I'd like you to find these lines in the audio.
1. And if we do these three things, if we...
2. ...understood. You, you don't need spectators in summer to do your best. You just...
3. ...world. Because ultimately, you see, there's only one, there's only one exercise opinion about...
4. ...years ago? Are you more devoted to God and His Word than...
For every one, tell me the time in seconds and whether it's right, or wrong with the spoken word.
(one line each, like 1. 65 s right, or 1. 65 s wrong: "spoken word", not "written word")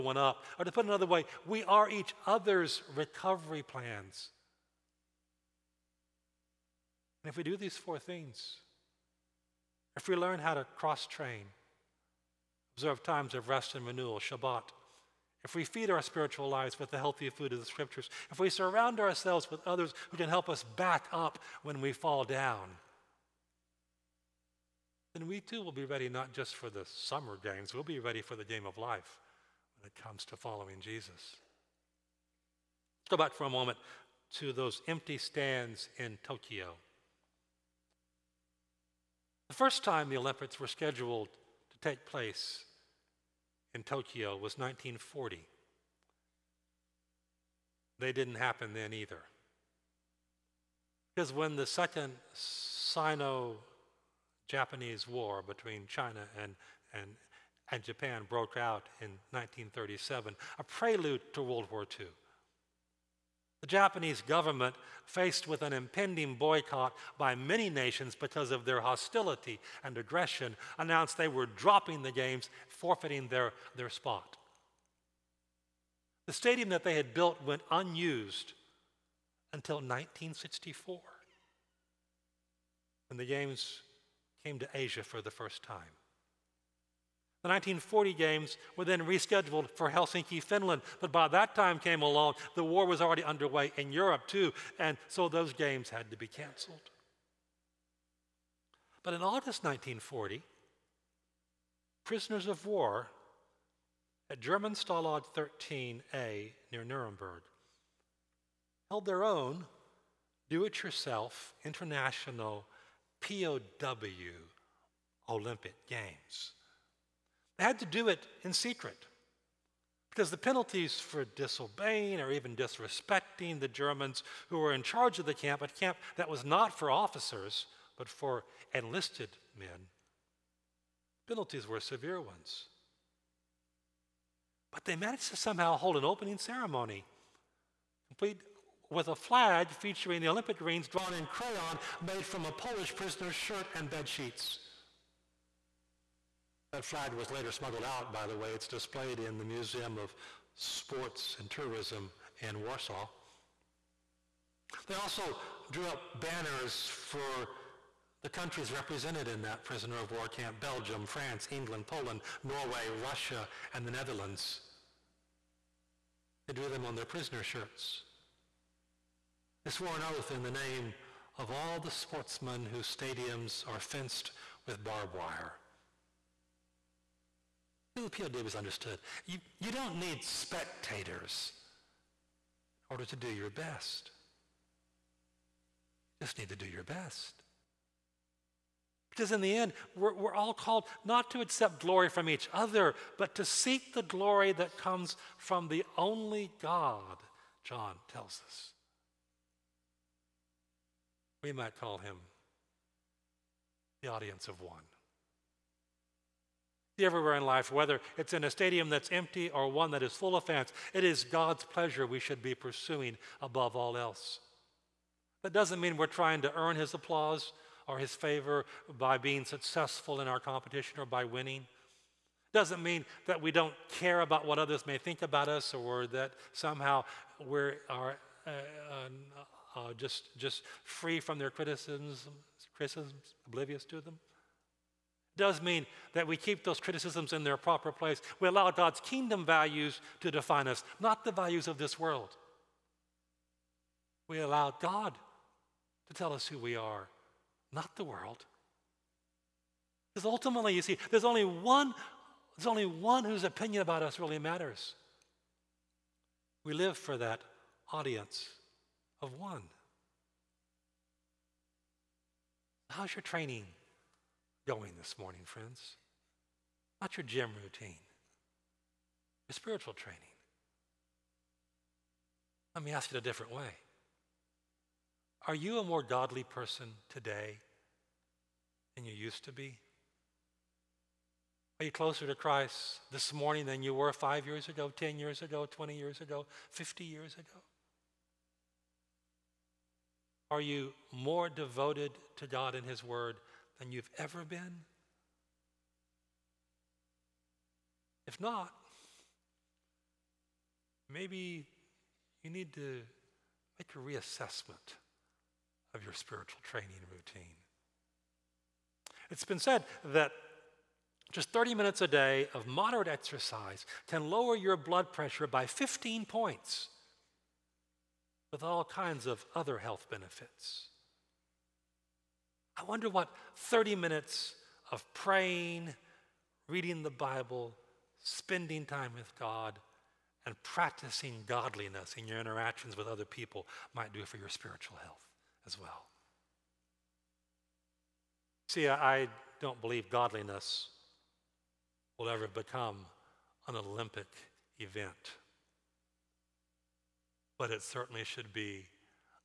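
1. 7 s wrong: "four", not "three"
2. 178 s wrong: "order", not "summer"
3. 248 s wrong: "whose", not "exercise"
4. 287 s right.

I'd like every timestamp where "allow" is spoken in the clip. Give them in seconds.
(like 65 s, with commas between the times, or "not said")
238 s, 244 s.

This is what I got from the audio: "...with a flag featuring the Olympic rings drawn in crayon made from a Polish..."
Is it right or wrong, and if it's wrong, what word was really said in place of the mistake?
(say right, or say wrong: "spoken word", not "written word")
right.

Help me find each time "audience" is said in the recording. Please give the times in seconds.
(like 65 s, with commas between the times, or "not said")
204 s, 257 s.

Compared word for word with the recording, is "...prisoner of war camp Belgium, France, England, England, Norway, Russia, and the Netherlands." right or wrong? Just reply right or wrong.
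wrong.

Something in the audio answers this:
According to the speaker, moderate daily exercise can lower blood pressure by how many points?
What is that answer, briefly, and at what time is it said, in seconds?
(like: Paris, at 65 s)
15, at 315 s.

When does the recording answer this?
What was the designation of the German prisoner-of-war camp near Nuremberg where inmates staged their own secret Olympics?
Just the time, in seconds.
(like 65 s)
104 s.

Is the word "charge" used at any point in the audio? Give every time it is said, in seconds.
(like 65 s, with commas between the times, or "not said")
124 s.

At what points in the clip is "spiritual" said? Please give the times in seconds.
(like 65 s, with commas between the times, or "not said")
16 s, 269 s, 306 s, 334 s.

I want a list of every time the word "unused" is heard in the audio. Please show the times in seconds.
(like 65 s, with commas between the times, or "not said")
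77 s.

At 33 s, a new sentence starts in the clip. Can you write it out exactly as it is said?
Let's go back for a moment to those empty stands in Tokyo.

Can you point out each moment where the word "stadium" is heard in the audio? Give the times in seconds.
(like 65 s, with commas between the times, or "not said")
76 s, 172 s, 208 s.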